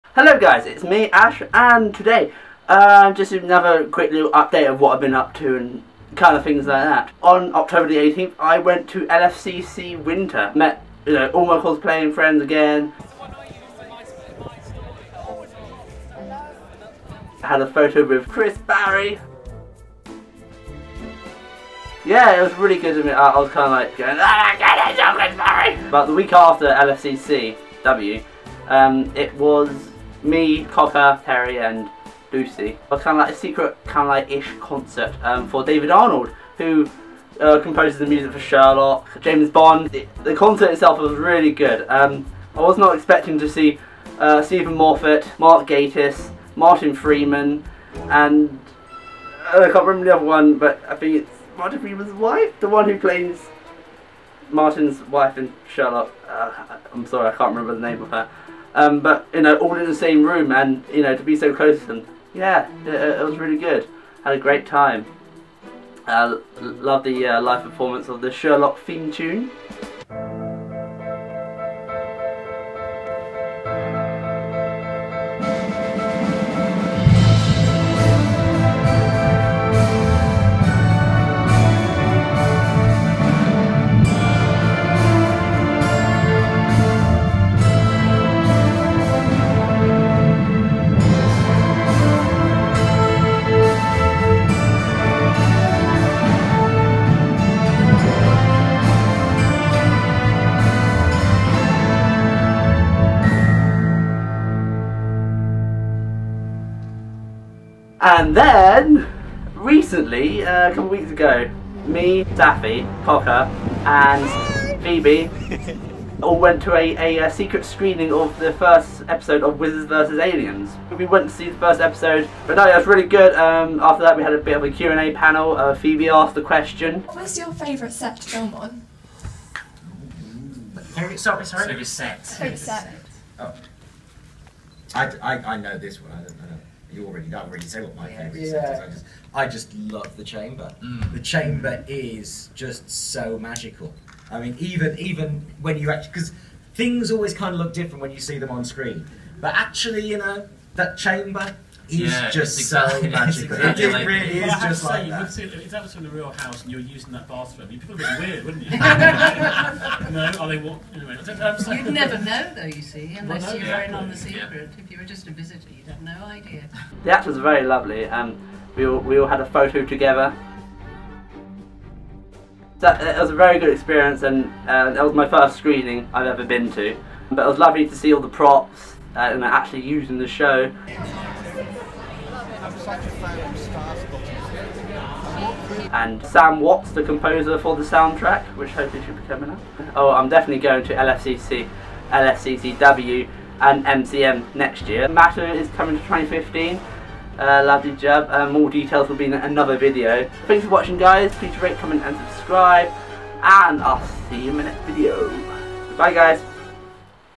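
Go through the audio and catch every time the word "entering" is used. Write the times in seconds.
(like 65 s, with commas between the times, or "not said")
not said.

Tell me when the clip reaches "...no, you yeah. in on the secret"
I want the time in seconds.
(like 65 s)
163 s.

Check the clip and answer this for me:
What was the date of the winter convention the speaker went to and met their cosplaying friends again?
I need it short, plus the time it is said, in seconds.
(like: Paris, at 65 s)
October 18, at 7 s.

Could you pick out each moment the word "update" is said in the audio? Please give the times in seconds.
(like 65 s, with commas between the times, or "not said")
4 s.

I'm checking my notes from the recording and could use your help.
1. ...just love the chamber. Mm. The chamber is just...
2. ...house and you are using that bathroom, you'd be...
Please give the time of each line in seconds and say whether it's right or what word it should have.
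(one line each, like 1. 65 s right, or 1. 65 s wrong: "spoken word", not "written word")
1. 139 s right
2. 156 s right.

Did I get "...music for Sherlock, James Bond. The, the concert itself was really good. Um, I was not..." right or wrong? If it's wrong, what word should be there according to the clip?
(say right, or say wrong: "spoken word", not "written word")
right.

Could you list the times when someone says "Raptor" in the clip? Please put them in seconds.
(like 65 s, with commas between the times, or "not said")
not said.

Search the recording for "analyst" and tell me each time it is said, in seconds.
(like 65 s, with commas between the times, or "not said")
not said.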